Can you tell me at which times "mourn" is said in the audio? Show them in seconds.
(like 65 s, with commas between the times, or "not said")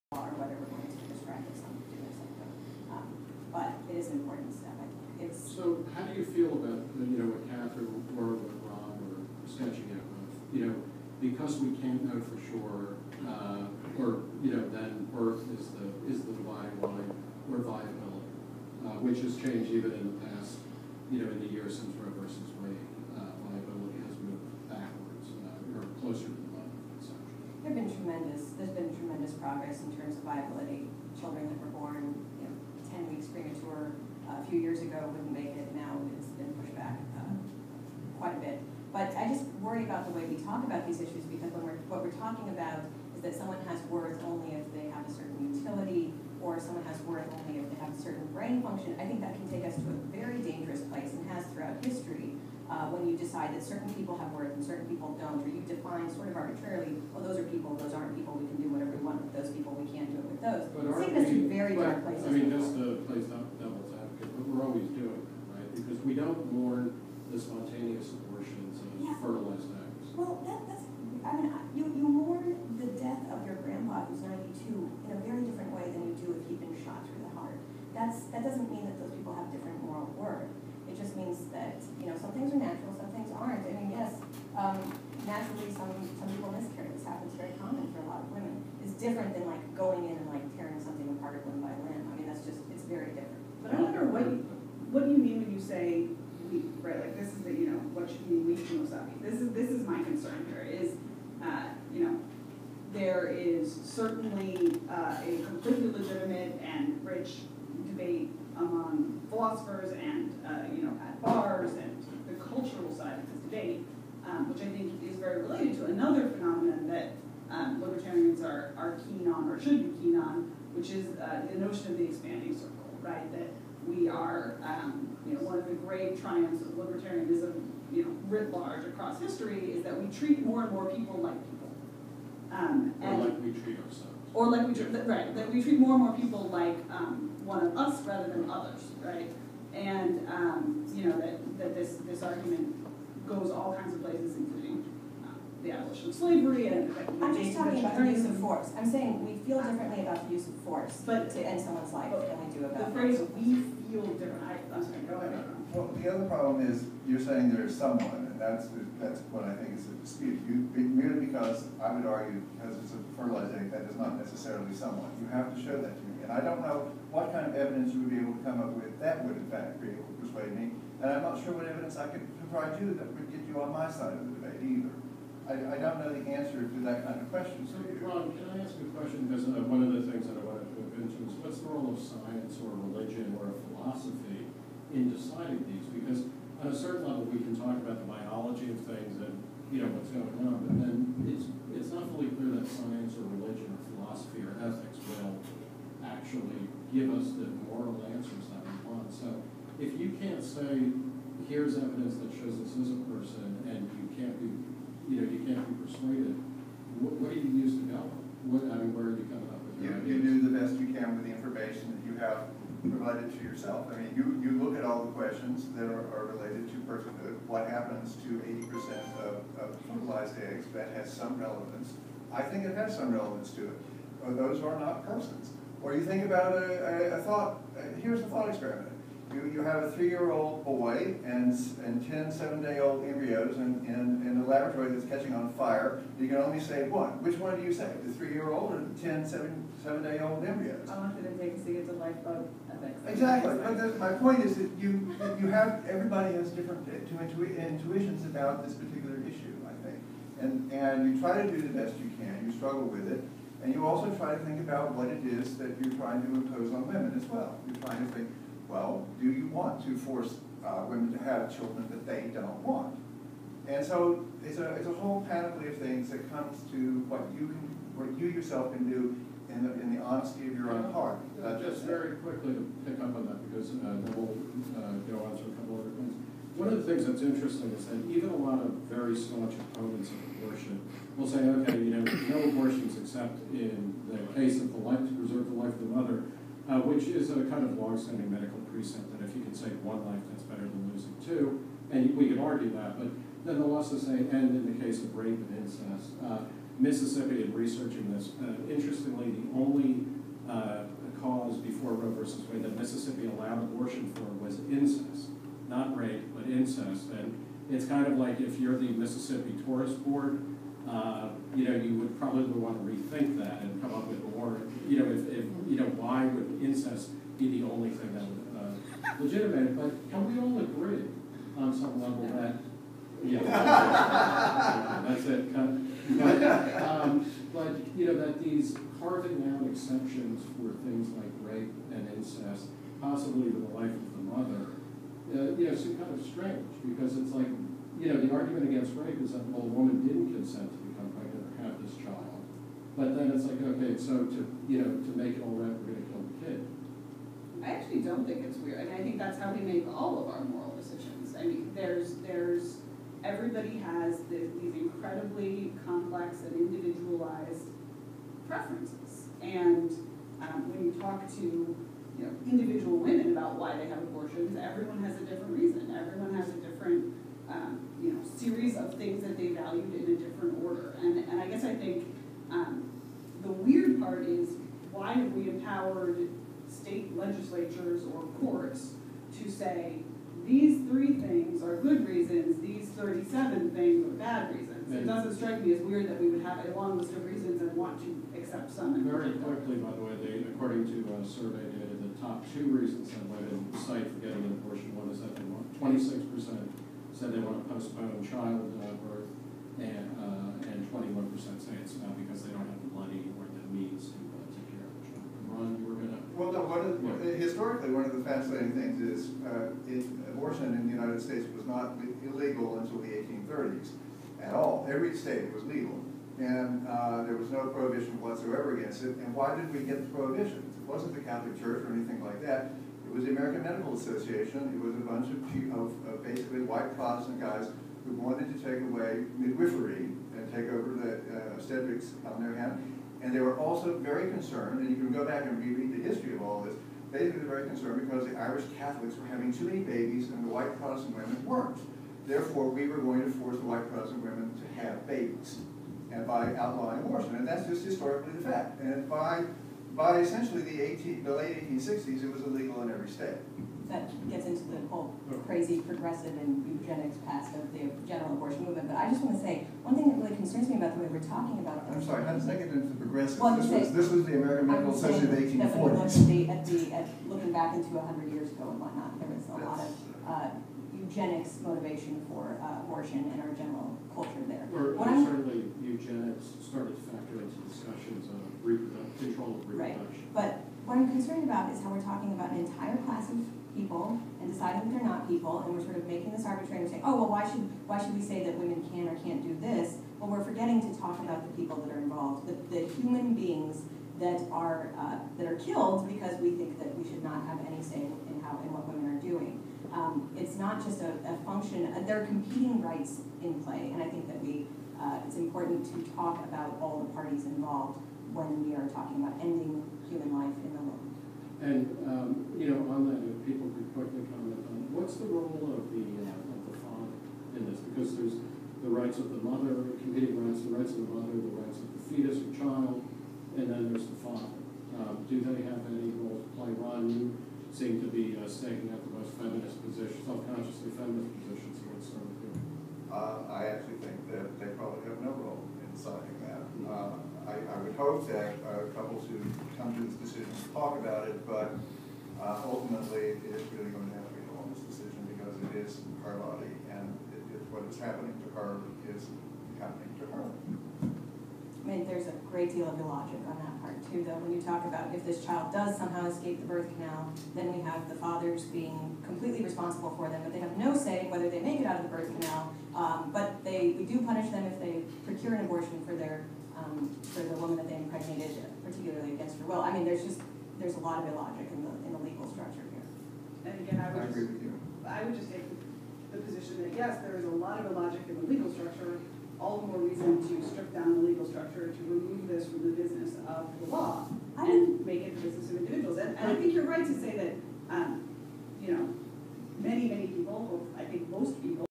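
66 s, 72 s.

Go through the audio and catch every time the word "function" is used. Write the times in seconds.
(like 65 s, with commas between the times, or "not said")
48 s, 501 s.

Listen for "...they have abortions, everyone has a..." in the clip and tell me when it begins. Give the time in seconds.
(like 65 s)
363 s.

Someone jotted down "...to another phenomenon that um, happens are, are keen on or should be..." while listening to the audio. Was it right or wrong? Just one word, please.
wrong.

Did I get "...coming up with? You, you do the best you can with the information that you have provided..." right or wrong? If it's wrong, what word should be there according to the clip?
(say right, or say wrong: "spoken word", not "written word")
right.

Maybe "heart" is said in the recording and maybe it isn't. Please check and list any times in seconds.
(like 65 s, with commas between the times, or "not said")
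77 s, 270 s.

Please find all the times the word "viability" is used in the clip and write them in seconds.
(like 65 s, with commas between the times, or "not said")
17 s, 23 s, 30 s.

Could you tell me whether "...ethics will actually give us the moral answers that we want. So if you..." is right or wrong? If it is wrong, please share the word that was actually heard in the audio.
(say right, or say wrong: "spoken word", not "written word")
right.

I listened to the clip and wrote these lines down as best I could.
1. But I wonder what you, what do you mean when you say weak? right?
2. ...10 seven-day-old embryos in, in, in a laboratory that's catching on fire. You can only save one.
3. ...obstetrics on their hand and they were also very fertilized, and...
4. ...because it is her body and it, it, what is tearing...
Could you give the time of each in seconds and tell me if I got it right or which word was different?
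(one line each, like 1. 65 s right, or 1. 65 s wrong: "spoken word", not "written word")
1. 93 s right
2. 232 s right
3. 431 s wrong: "concerned", not "fertilized"
4. 545 s wrong: "happening", not "tearing".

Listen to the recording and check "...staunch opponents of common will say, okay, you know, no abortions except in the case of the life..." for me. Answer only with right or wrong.
wrong.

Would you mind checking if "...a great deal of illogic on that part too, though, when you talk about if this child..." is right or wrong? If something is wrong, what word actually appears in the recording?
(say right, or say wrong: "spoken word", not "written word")
right.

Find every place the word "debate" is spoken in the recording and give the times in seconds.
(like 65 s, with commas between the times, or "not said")
107 s, 174 s.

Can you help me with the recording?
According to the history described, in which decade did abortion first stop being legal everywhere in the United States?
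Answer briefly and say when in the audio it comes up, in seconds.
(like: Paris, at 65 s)
1830s, at 413 s.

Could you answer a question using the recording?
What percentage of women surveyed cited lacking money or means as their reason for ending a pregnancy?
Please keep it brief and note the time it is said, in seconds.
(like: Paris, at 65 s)
21%, at 400 s.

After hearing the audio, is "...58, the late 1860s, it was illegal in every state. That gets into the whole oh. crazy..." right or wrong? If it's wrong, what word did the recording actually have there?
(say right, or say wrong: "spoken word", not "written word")
wrong: "18", not "58".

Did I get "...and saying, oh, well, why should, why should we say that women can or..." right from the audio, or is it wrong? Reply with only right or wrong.
right.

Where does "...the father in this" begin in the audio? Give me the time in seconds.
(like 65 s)
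516 s.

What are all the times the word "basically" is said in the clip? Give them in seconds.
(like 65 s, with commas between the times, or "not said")
426 s.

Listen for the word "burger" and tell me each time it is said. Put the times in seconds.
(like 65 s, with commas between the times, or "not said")
not said.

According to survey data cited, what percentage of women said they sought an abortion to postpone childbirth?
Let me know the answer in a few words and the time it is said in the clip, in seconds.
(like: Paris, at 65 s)
26%, at 395 s.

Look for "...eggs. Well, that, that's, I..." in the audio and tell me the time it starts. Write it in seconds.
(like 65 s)
69 s.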